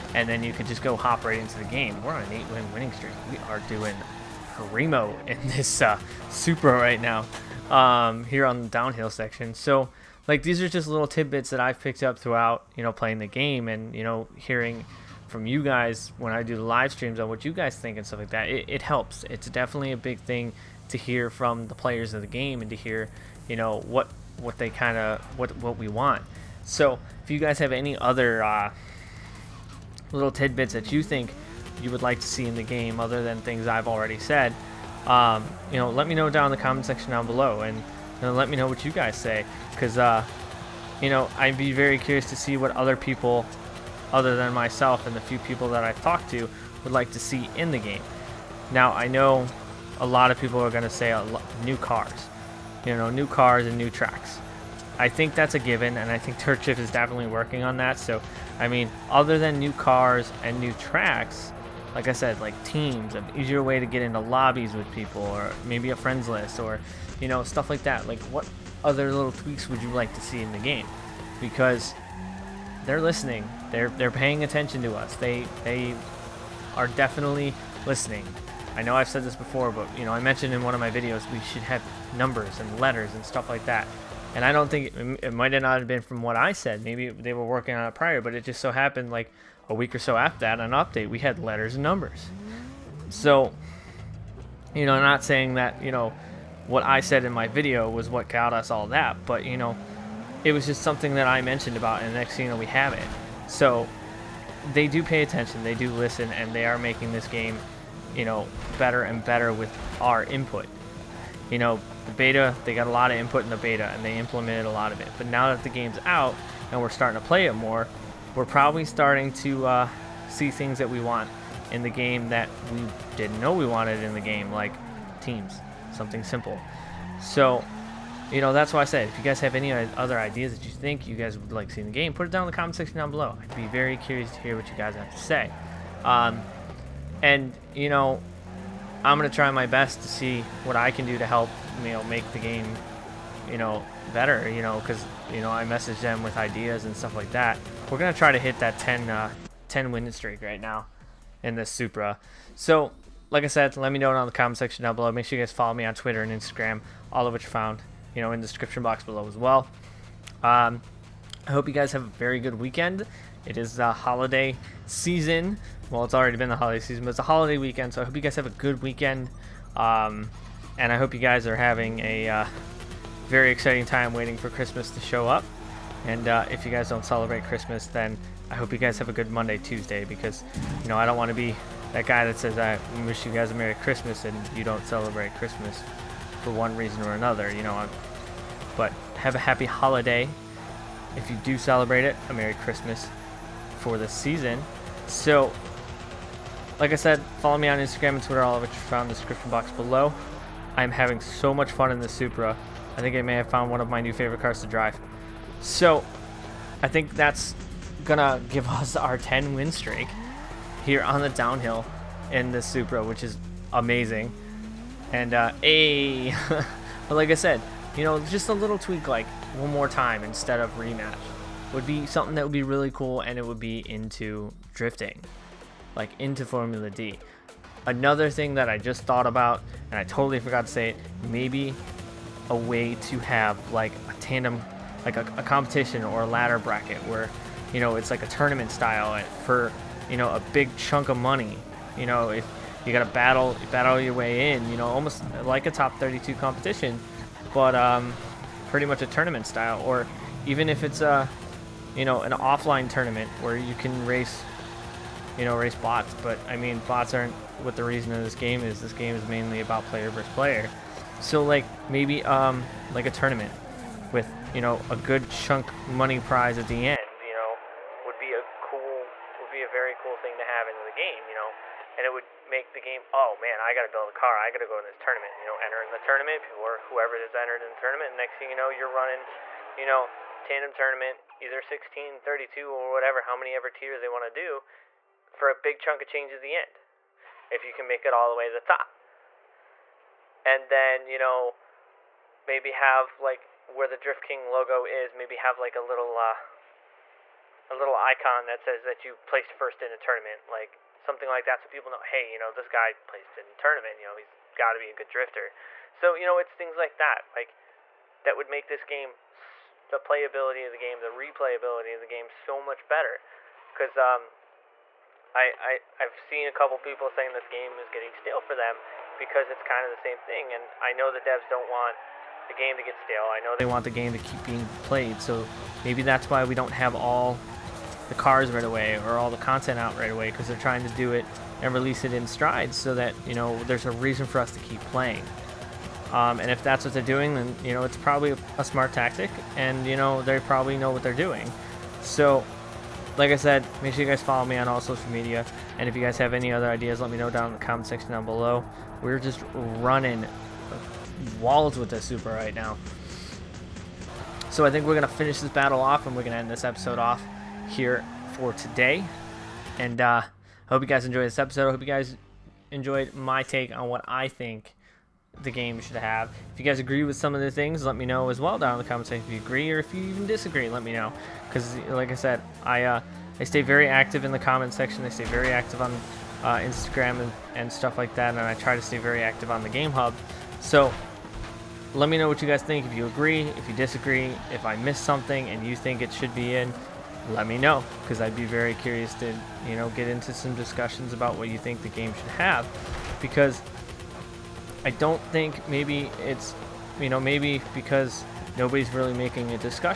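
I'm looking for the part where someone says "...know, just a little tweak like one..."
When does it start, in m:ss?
3:38.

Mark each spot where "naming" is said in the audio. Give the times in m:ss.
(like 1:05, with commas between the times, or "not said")
not said.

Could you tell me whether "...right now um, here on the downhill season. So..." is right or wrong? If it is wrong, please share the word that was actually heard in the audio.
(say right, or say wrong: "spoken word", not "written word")
wrong: "section", not "season".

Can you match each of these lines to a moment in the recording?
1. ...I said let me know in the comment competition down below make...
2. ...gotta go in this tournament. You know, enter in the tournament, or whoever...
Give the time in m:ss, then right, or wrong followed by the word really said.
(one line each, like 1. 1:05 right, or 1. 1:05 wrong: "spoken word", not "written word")
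1. 2:33 wrong: "section", not "competition"
2. 4:34 right.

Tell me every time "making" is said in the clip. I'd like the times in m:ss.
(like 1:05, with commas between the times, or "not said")
1:46, 6:39.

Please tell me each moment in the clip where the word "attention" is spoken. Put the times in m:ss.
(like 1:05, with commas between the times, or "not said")
1:14, 1:45.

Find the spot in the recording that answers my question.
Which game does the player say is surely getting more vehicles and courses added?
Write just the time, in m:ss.
0:56.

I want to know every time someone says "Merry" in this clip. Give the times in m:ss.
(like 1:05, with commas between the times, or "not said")
3:03, 3:12.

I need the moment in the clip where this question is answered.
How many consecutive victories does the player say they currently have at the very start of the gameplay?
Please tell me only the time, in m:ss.
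0:02.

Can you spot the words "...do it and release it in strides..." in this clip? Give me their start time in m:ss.
5:30.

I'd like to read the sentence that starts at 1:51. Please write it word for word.
You know, the beta, they got a lot of input in the beta and they implemented a lot of it.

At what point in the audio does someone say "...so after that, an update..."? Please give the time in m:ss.
1:29.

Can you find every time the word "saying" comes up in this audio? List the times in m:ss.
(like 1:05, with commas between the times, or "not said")
1:35, 5:17.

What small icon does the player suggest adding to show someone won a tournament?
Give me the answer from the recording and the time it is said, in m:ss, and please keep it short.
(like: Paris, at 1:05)
Drift King logo, at 4:53.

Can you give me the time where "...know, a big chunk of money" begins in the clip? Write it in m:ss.
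4:00.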